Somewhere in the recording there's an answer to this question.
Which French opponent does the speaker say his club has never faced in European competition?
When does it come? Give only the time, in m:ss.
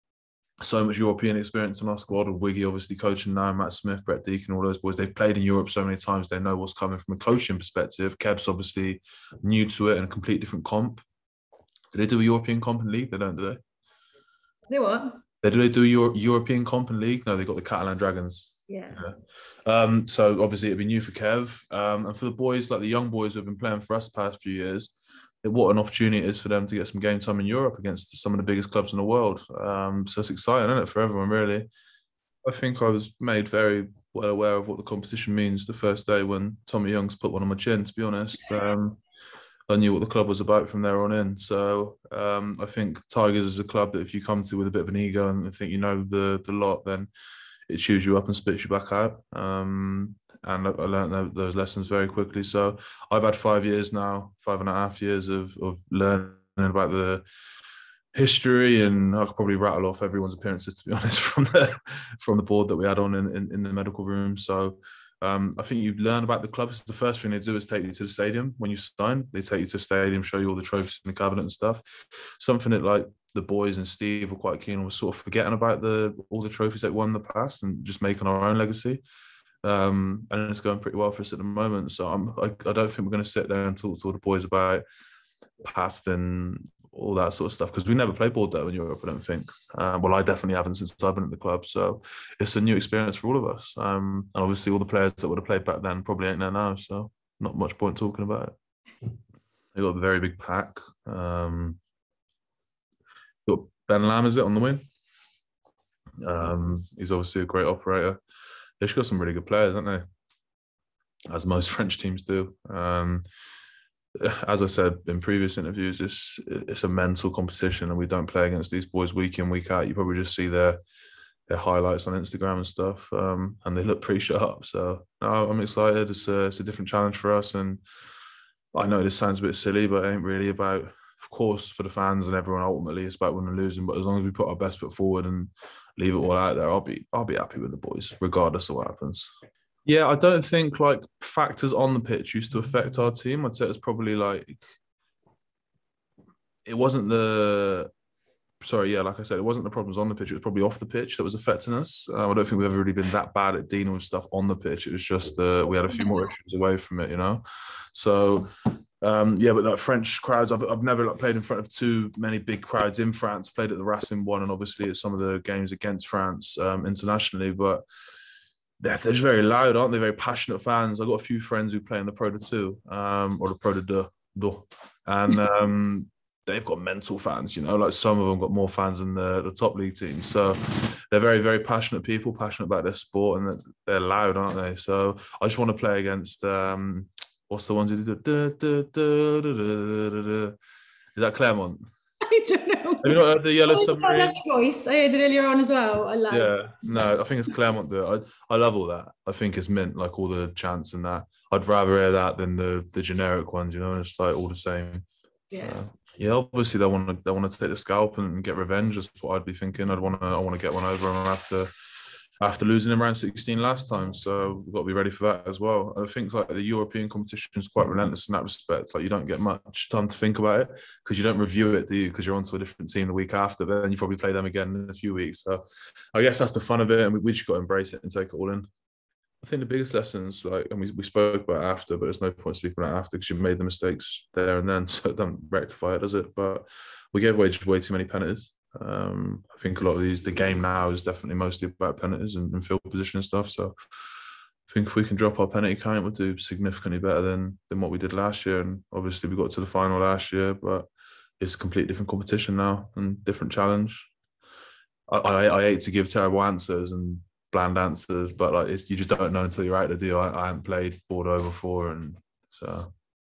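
1:28.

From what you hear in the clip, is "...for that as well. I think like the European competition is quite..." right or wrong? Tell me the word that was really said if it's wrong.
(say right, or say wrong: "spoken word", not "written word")
right.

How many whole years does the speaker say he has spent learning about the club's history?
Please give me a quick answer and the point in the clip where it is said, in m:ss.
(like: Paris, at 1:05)
5, at 0:53.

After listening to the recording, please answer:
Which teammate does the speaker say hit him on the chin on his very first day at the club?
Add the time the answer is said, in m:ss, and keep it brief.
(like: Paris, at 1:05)
Tommy Youngs, at 0:36.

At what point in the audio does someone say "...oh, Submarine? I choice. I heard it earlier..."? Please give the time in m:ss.
3:13.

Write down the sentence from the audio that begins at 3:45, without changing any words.
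So I guess that's the fun of it, and we, we just got to embrace it and take it all in.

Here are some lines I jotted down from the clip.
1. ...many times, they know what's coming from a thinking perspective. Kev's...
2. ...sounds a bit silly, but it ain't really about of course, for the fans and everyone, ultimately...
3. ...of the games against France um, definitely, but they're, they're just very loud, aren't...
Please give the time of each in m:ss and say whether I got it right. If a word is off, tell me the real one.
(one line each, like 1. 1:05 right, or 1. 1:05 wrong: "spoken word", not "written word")
1. 0:05 wrong: "coaching", not "thinking"
2. 2:09 right
3. 2:45 wrong: "internationally", not "definitely".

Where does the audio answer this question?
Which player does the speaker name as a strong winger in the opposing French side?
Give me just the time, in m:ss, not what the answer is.
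1:43.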